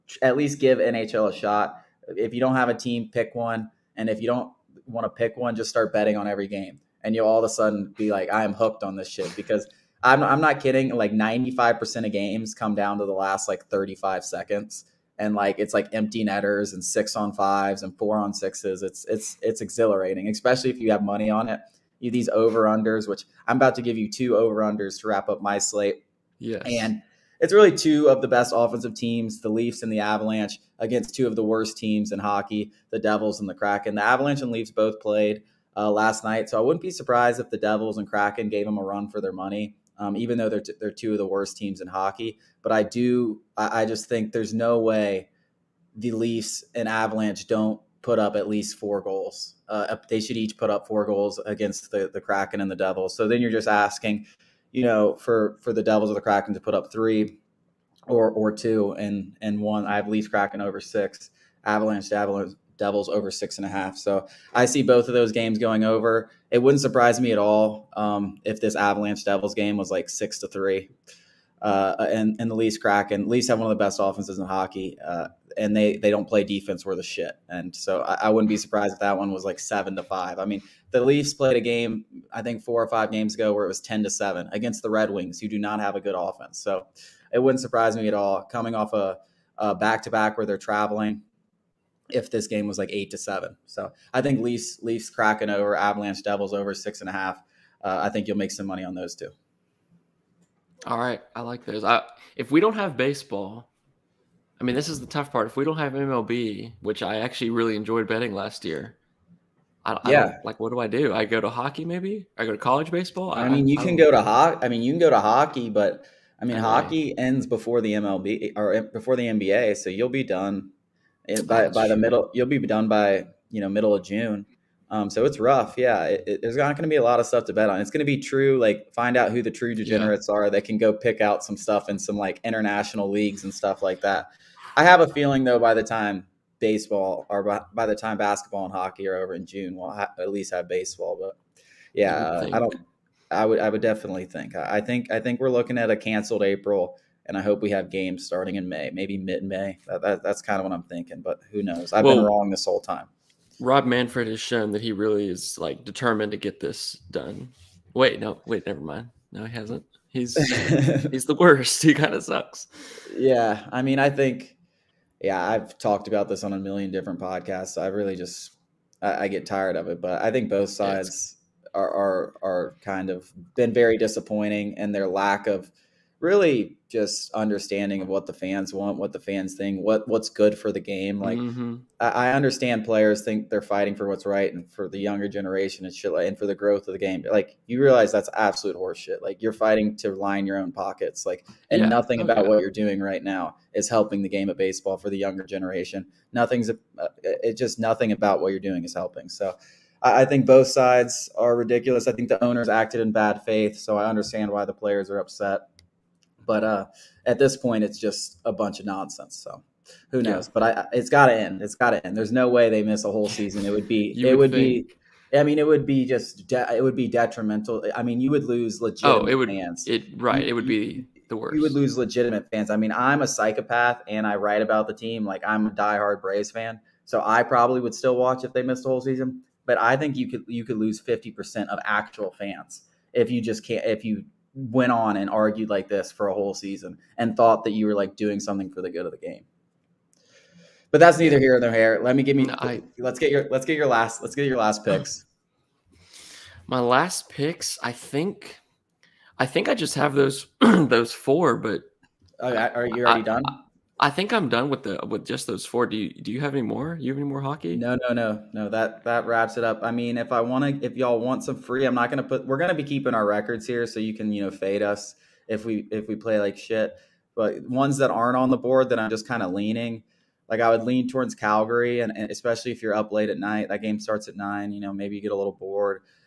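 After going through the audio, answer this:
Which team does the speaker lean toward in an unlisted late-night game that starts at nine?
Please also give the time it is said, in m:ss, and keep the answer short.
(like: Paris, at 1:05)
Calgary, at 4:31.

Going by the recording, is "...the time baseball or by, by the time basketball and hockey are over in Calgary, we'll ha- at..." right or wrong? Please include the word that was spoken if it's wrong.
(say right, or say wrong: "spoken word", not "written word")
wrong: "June", not "Calgary".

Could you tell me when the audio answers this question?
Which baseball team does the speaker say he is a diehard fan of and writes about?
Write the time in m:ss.
3:46.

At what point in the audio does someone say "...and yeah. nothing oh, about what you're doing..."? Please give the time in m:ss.
3:11.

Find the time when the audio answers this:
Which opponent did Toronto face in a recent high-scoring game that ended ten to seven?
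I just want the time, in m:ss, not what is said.
1:24.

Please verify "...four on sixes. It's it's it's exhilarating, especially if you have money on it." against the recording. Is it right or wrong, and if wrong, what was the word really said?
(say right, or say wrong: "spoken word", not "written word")
right.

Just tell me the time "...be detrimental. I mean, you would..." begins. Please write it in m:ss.
3:36.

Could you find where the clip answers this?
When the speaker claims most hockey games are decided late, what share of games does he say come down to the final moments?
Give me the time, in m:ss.
0:11.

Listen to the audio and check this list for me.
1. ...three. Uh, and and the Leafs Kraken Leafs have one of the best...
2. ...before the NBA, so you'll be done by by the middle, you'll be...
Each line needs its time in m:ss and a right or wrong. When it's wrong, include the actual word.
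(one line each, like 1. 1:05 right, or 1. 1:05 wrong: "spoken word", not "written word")
1. 1:10 right
2. 1:58 right.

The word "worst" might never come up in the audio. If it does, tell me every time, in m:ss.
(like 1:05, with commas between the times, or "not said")
0:31, 0:41, 2:41, 3:41.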